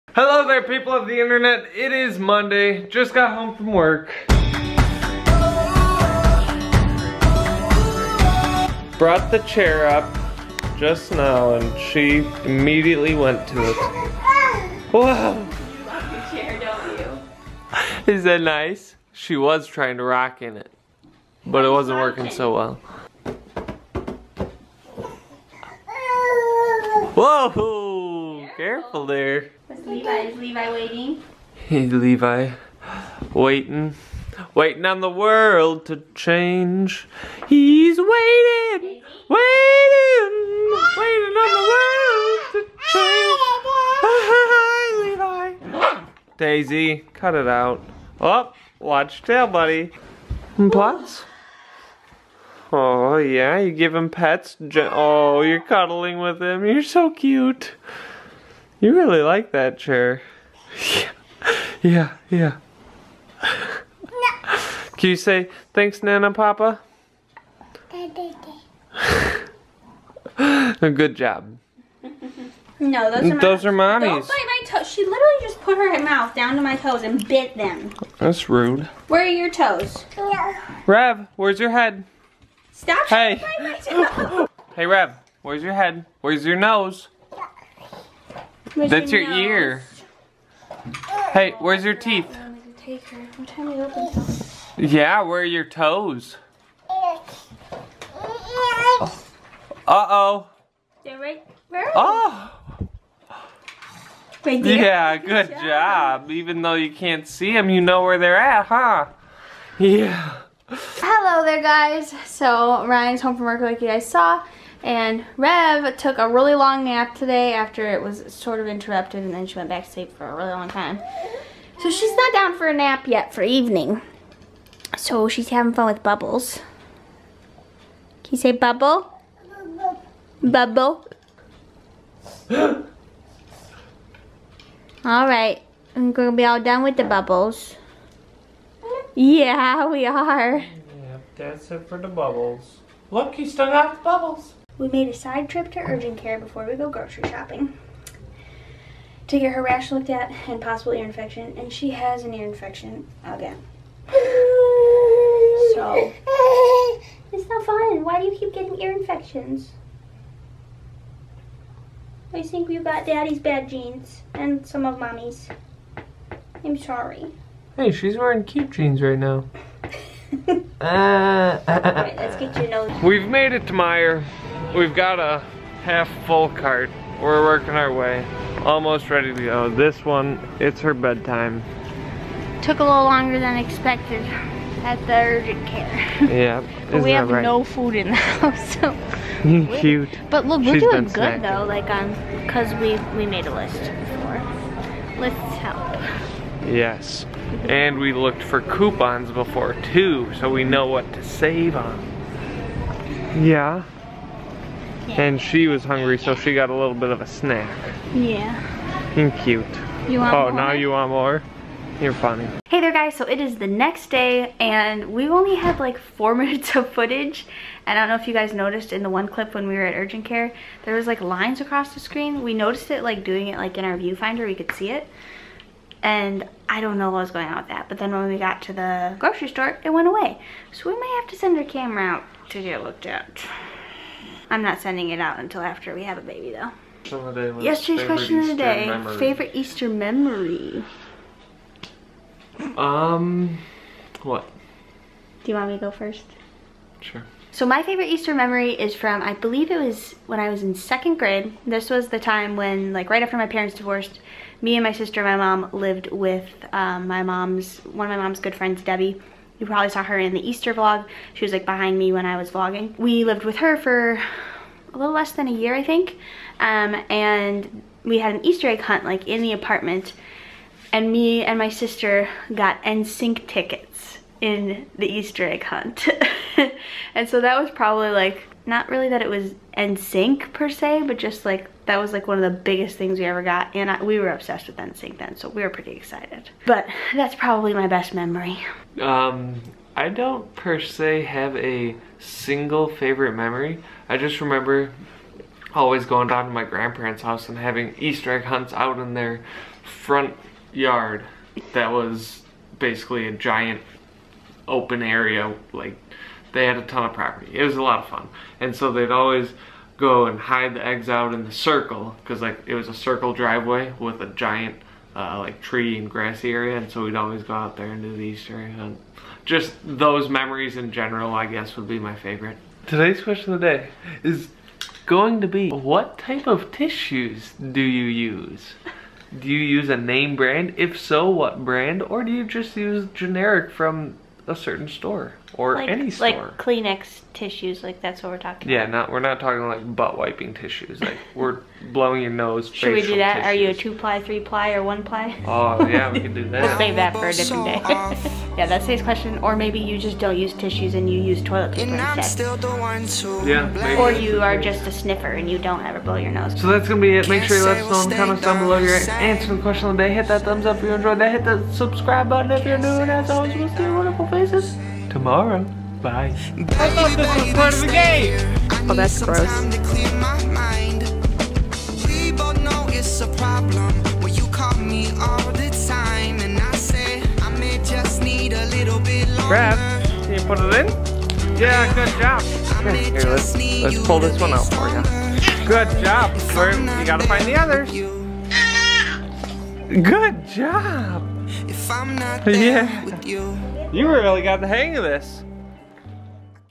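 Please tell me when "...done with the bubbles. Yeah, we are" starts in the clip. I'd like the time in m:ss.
2:16.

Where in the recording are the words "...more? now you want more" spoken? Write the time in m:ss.
3:30.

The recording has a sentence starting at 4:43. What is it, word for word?
And I, we were obsessed with NSYNC then, so we were pretty excited.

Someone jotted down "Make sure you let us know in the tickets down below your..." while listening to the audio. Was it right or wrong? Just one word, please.
wrong.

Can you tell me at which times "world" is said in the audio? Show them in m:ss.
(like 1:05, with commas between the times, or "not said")
0:35, 0:41.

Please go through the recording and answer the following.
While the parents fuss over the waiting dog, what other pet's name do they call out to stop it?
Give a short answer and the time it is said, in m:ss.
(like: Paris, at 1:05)
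Daisy, at 0:46.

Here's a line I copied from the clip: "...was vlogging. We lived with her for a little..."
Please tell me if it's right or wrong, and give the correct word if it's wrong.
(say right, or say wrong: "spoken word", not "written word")
right.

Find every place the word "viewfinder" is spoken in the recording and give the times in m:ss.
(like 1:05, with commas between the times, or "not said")
3:43.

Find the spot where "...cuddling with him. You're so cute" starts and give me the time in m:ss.
0:55.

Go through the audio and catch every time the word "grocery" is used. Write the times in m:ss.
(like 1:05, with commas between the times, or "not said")
2:26, 3:49.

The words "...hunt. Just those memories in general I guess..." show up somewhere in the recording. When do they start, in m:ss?
5:18.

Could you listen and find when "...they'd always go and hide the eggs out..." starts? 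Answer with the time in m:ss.
5:08.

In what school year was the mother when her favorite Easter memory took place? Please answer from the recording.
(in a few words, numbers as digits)
Second grade.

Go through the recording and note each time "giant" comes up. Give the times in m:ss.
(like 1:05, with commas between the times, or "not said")
5:03, 5:14.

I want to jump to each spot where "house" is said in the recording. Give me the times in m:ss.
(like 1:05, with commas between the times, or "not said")
3:08, 4:57.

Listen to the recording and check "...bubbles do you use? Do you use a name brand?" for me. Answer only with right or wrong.
wrong.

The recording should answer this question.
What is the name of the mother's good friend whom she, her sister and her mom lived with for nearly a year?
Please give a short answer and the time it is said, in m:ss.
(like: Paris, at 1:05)
Debbie, at 4:18.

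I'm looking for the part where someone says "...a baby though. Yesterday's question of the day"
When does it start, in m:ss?
3:56.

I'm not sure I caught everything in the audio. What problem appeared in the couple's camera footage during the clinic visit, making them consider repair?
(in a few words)
Lines across the screen.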